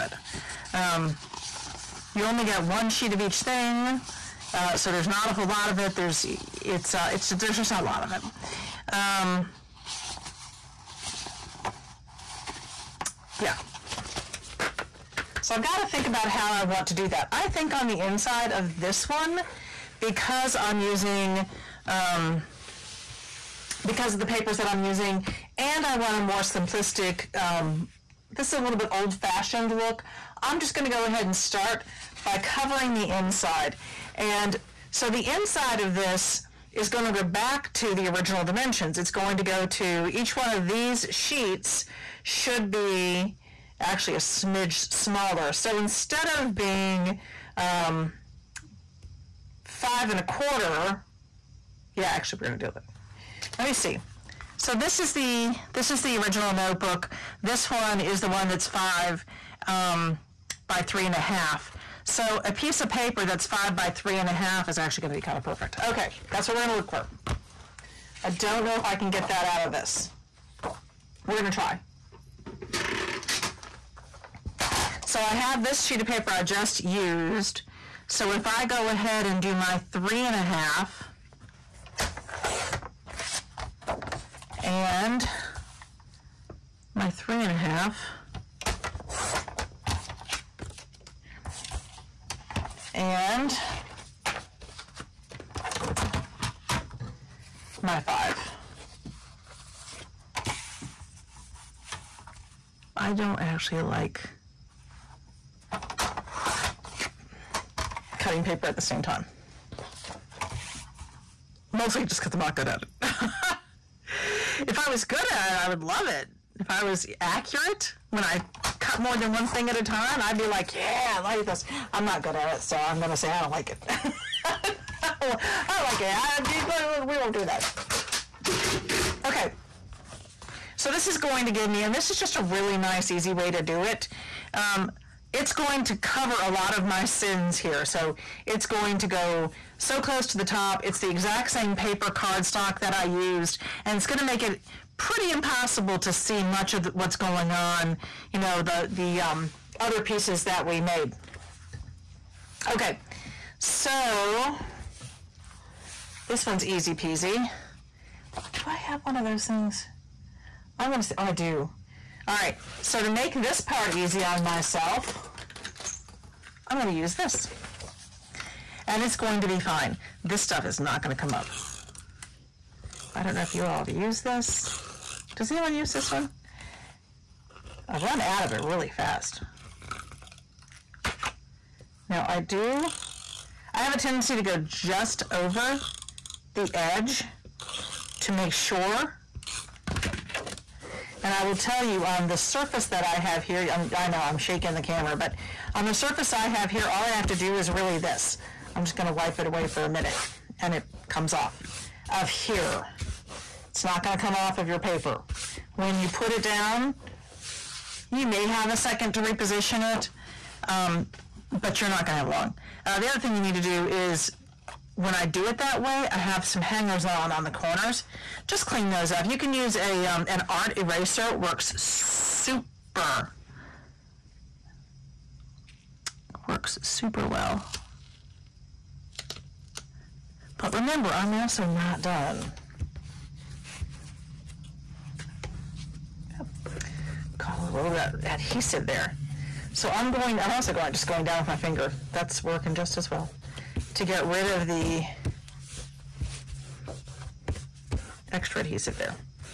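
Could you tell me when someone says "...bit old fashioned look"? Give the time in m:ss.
0:28.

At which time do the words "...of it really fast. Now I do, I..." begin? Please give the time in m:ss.
2:58.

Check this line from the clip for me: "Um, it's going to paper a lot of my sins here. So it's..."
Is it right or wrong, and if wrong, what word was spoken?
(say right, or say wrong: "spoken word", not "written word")
wrong: "cover", not "paper".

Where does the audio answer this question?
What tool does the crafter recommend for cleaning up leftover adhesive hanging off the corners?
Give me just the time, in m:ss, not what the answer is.
3:40.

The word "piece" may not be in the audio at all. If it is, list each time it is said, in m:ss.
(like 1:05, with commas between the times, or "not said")
1:02, 2:30.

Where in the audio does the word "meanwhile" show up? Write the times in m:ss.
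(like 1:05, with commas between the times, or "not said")
not said.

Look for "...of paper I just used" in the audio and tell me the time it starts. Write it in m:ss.
1:16.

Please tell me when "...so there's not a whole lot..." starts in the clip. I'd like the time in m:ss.
0:04.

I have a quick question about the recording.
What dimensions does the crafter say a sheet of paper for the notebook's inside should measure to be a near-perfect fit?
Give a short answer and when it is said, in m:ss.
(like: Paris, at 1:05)
5 by 3.5, at 1:03.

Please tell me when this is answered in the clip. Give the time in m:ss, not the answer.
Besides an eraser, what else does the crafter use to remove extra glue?
4:01.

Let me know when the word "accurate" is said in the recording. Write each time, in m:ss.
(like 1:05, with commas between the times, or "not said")
1:57.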